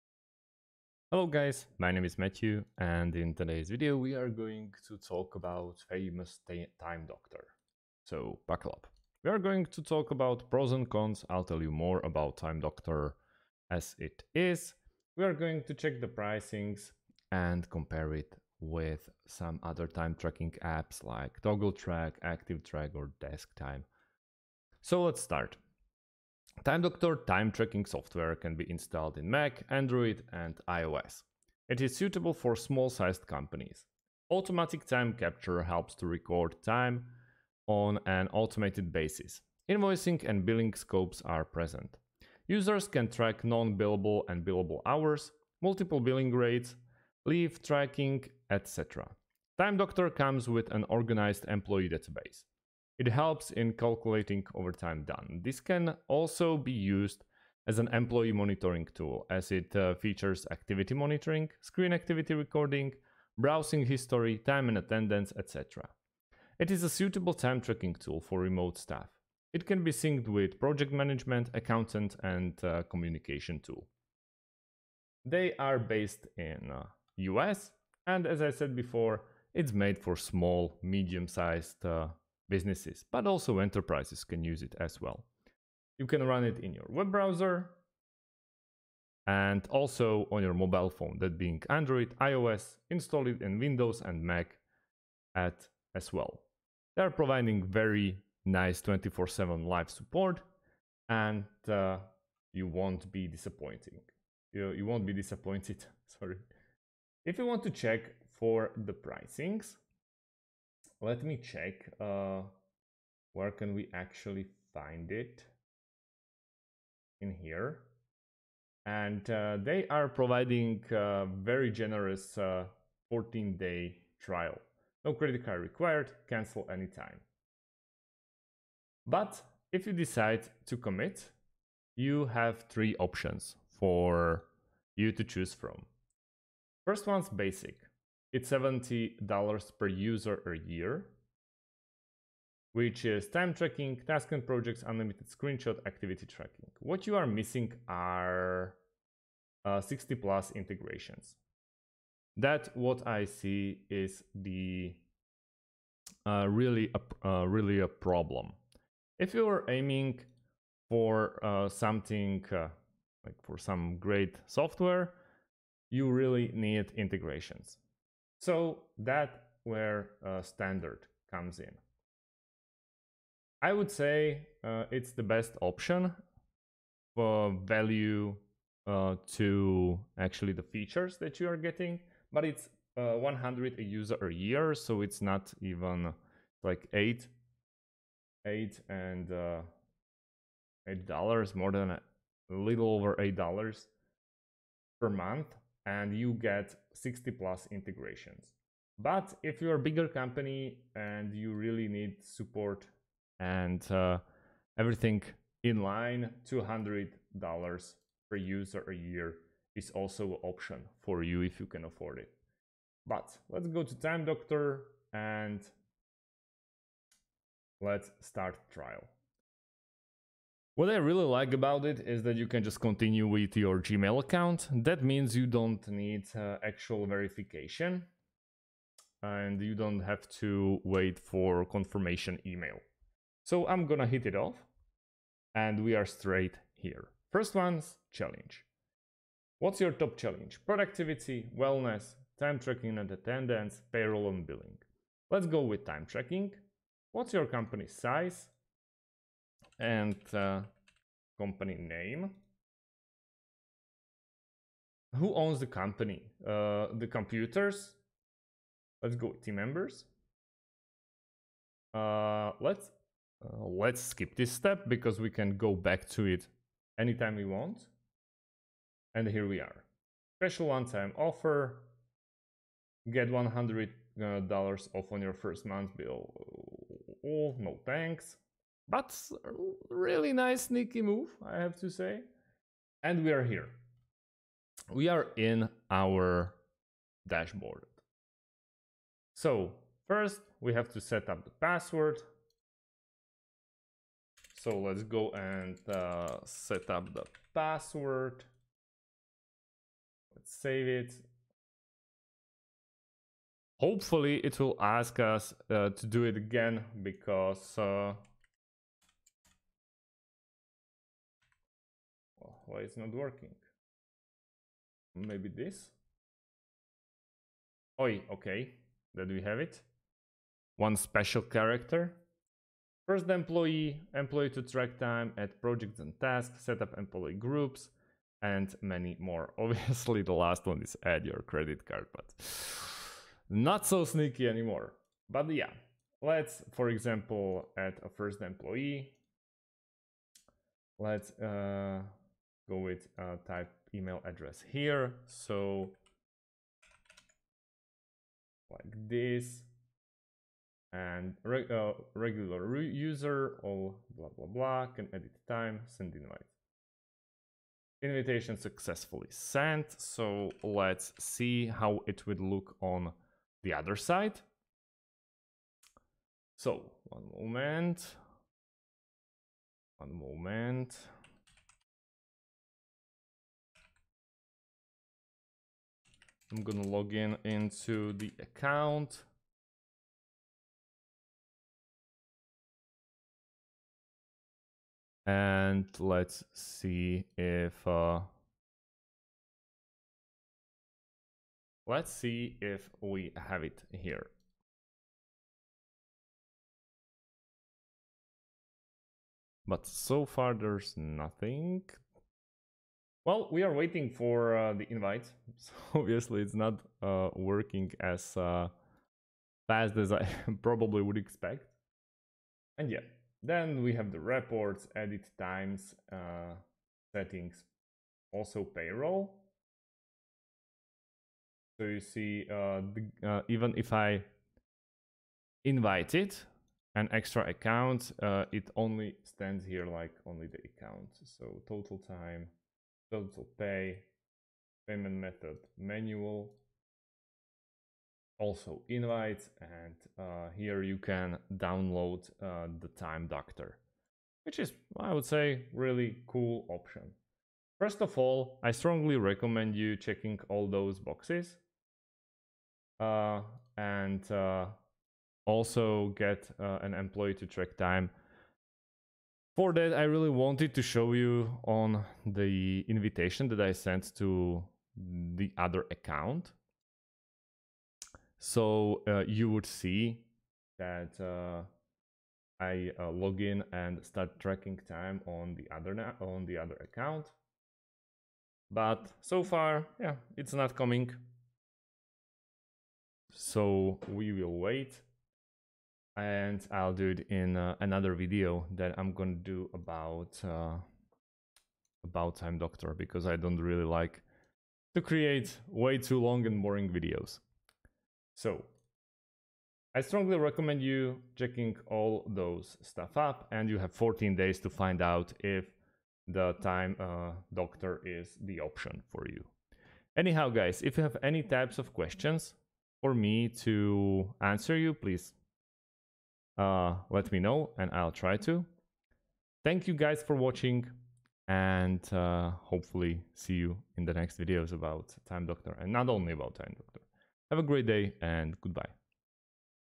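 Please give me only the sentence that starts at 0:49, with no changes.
Time Doctor comes with an organized employee database.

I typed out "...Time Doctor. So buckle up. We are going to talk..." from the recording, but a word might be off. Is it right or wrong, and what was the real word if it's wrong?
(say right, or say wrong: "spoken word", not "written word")
right.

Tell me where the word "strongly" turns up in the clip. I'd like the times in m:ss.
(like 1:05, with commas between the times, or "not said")
7:28, 8:20.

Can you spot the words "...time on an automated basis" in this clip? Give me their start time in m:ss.
0:36.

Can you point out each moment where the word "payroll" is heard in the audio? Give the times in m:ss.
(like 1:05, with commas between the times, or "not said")
4:03, 6:58.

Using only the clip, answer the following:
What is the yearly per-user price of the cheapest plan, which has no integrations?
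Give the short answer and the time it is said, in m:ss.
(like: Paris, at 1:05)
$70, at 2:18.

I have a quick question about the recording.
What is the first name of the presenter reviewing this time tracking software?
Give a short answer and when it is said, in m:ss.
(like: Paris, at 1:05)
Matthew, at 0:02.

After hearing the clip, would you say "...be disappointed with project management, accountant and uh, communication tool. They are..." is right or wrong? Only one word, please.
wrong.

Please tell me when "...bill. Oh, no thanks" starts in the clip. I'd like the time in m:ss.
4:35.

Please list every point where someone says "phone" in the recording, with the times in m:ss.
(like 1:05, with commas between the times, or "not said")
1:30.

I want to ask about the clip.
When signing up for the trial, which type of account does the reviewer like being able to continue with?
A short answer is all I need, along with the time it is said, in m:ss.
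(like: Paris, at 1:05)
Gmail, at 3:43.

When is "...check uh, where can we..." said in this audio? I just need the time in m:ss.
1:51.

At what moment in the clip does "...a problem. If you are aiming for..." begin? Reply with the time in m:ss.
2:37.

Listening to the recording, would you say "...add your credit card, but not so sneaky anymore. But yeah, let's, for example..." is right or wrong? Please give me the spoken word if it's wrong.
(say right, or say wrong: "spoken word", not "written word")
right.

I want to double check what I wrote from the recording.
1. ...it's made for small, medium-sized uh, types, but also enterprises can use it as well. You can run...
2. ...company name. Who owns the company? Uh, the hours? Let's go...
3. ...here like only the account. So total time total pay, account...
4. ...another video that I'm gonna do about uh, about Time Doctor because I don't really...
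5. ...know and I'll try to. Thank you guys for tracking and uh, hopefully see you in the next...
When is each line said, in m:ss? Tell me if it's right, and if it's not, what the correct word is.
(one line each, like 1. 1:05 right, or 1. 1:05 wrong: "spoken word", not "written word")
1. 1:19 wrong: "businesses", not "types"
2. 4:11 wrong: "computers", not "hours"
3. 7:09 wrong: "payment", not "account"
4. 8:07 right
5. 8:37 wrong: "watching", not "tracking".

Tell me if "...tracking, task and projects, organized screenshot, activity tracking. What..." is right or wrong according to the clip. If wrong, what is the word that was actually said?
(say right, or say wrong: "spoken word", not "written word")
wrong: "unlimited", not "organized".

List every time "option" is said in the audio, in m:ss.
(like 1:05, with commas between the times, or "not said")
2:12, 2:55, 3:30, 7:26, 8:28.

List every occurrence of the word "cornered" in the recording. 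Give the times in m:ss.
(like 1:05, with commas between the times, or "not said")
not said.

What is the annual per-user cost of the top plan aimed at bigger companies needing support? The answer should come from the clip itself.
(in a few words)
$200.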